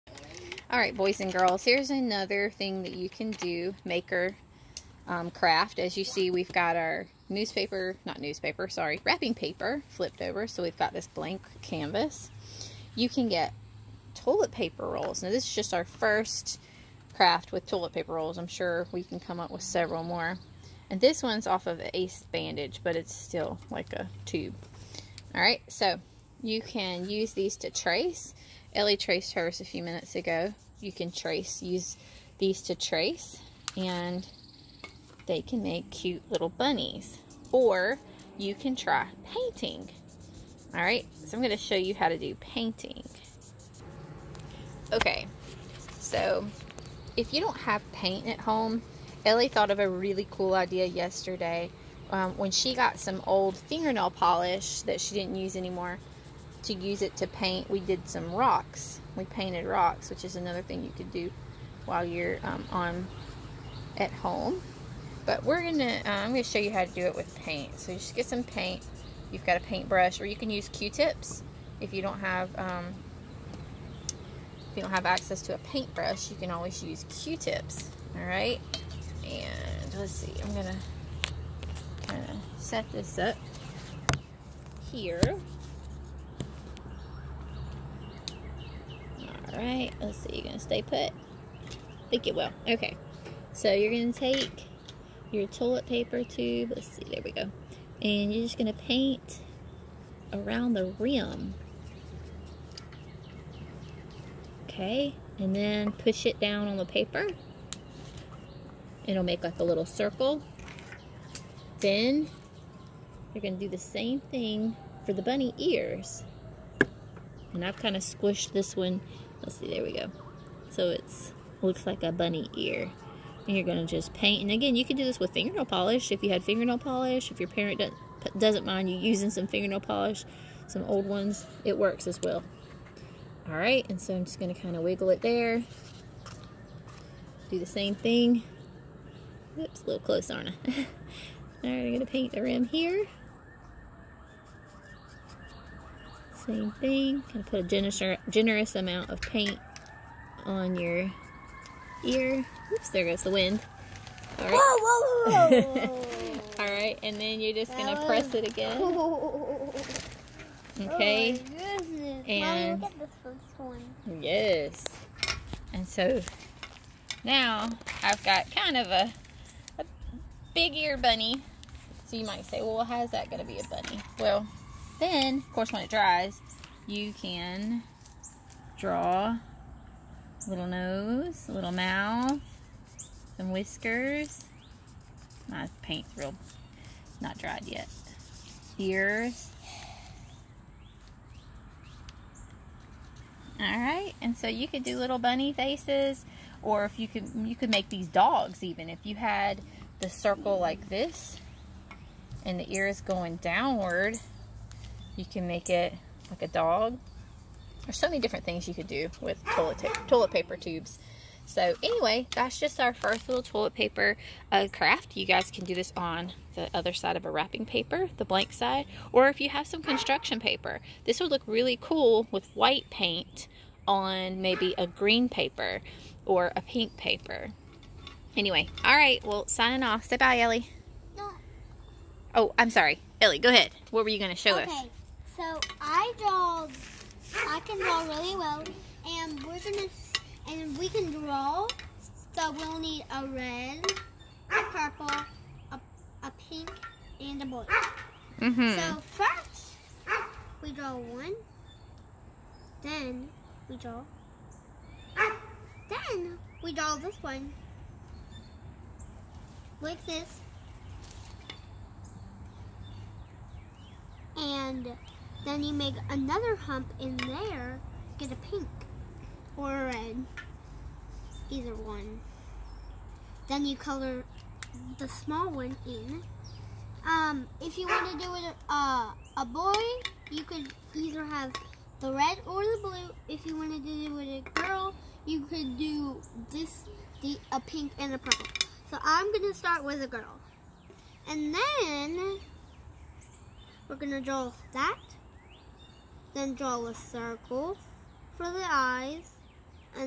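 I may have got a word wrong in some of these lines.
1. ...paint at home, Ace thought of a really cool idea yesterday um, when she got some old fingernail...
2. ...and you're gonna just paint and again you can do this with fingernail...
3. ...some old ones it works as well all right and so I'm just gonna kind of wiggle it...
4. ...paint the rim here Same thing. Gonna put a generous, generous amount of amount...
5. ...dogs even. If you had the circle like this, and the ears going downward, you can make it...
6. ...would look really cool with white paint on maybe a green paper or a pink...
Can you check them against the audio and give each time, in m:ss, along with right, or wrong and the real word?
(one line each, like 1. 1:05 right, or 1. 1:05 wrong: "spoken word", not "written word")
1. 0:47 wrong: "Elly", not "Ace"
2. 2:03 right
3. 2:10 right
4. 2:22 wrong: "paint", not "amount"
5. 3:18 right
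6. 3:41 right.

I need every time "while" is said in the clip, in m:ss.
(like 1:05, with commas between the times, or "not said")
1:01.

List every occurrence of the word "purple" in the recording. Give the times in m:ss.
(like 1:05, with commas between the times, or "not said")
4:04, 4:48.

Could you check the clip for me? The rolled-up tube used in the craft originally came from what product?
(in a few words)
Ace Bandage.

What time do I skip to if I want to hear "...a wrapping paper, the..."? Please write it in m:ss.
3:37.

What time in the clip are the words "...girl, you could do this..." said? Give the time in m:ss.
4:44.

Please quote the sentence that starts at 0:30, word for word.
You can trace, use these to trace, and they can make cute little bunnies.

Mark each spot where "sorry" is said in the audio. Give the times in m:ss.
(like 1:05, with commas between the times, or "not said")
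0:08, 3:52.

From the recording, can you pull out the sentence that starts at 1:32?
Okay, so you're gonna take your toilet paper tube, let's see, there we go.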